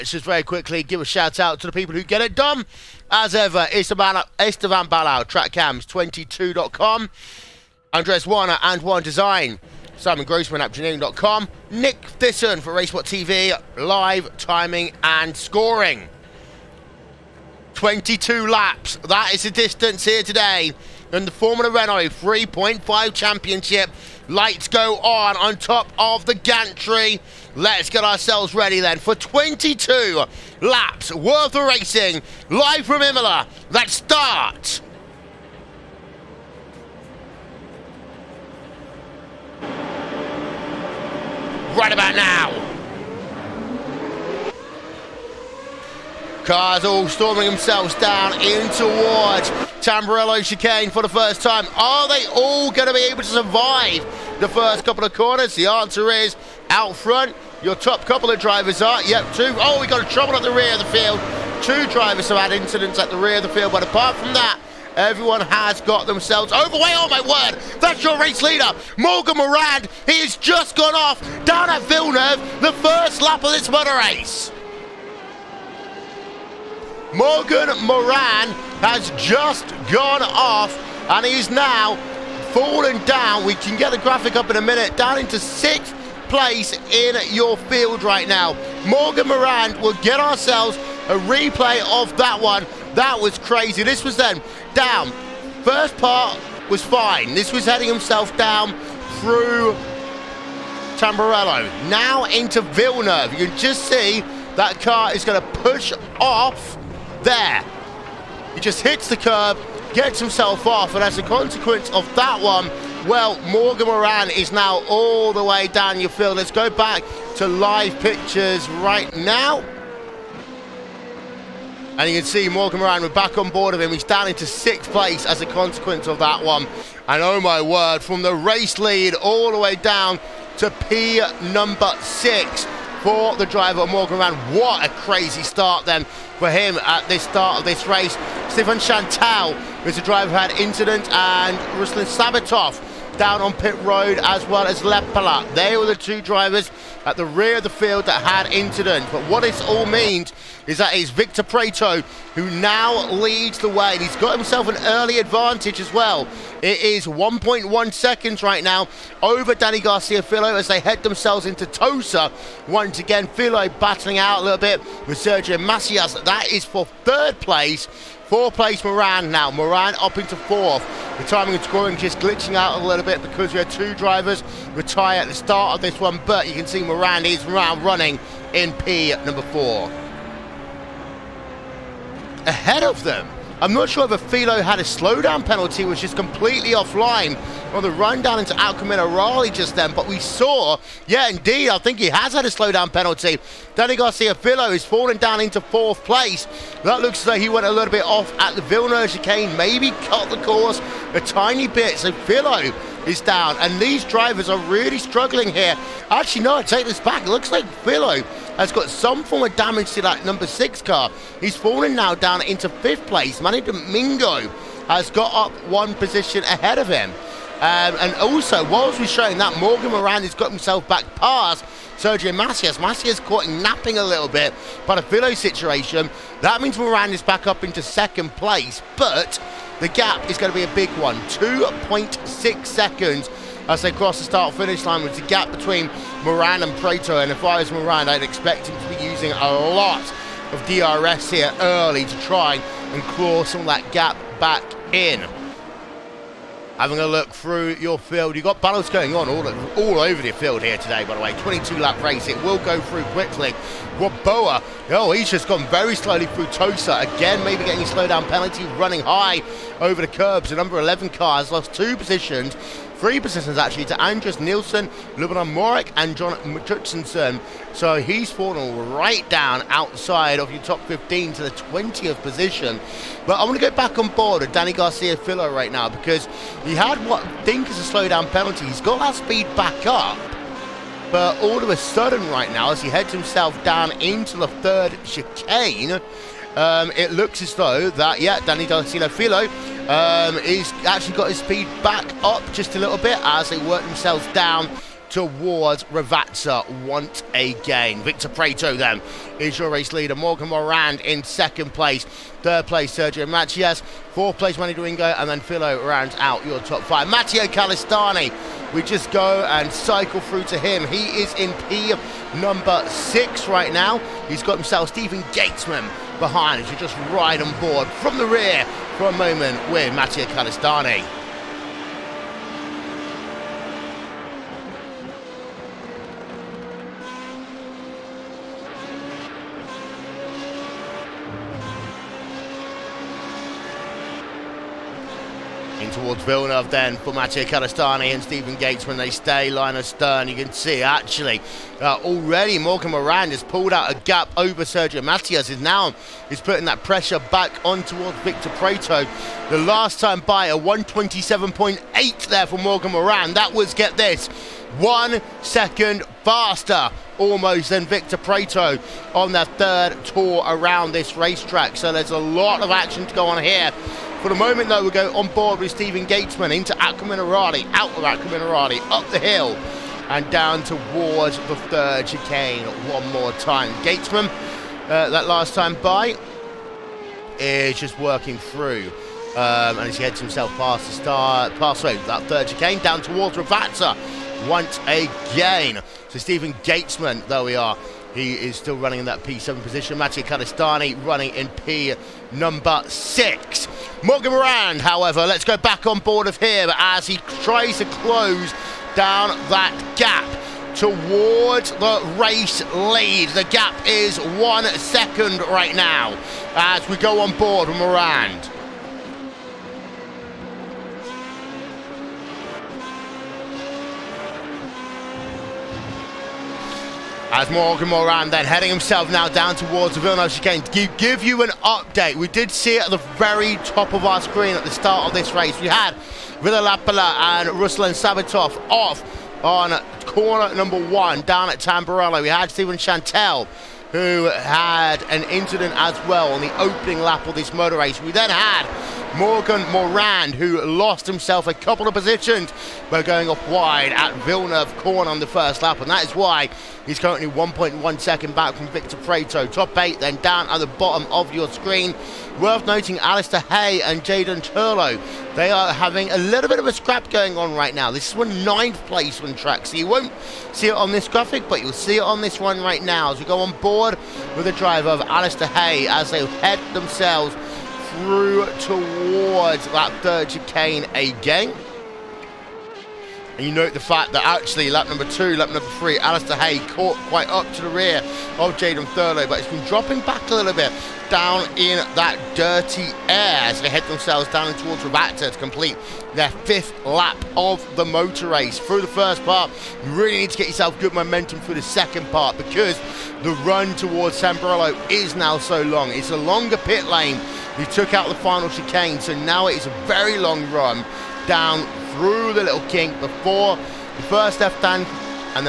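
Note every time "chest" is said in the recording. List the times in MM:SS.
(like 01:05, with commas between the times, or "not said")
not said.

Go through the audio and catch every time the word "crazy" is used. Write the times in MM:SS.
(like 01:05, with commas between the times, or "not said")
01:33, 02:15.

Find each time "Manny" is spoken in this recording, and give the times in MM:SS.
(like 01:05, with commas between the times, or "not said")
03:33, 05:04.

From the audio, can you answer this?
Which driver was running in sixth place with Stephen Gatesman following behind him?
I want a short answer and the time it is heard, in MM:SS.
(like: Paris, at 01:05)
Matteo Calistani, at 05:07.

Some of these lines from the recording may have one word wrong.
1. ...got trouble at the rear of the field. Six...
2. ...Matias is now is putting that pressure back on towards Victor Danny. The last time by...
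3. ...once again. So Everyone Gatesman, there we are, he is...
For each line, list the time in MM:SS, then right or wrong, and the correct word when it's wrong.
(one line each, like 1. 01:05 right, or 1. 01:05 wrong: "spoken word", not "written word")
1. 00:59 wrong: "Two", not "Six"
2. 05:45 wrong: "Prato", not "Danny"
3. 06:24 wrong: "Stephen", not "Everyone".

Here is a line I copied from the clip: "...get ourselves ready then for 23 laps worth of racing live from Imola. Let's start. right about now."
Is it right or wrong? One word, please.
wrong.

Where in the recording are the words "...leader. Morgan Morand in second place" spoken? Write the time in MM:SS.
04:59.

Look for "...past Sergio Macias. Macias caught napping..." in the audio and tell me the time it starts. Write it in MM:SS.
03:41.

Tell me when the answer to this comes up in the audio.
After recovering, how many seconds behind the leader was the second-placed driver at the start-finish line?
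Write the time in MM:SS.
03:51.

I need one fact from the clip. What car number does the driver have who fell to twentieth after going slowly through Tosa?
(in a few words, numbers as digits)
11.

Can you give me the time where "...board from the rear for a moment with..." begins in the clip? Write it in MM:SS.
05:17.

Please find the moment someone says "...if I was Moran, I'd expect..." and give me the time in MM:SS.
03:57.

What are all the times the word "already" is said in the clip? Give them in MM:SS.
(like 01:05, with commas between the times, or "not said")
05:42.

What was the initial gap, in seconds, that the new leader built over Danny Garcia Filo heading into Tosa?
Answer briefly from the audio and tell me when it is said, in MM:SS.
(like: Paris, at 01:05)
1.1 seconds, at 02:37.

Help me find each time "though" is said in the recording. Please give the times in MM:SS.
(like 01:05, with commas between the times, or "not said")
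04:47, 06:04.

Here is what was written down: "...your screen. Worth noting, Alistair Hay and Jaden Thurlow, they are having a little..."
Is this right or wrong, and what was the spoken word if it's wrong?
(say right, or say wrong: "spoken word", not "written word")
right.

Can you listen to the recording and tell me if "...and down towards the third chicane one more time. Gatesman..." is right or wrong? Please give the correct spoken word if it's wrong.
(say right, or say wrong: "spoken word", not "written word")
right.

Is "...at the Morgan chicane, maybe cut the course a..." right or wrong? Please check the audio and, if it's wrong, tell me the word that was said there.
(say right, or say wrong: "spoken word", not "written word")
wrong: "Villeneuve", not "Morgan".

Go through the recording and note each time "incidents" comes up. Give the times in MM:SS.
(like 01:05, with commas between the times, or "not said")
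01:02, 02:20, 02:28, 07:15.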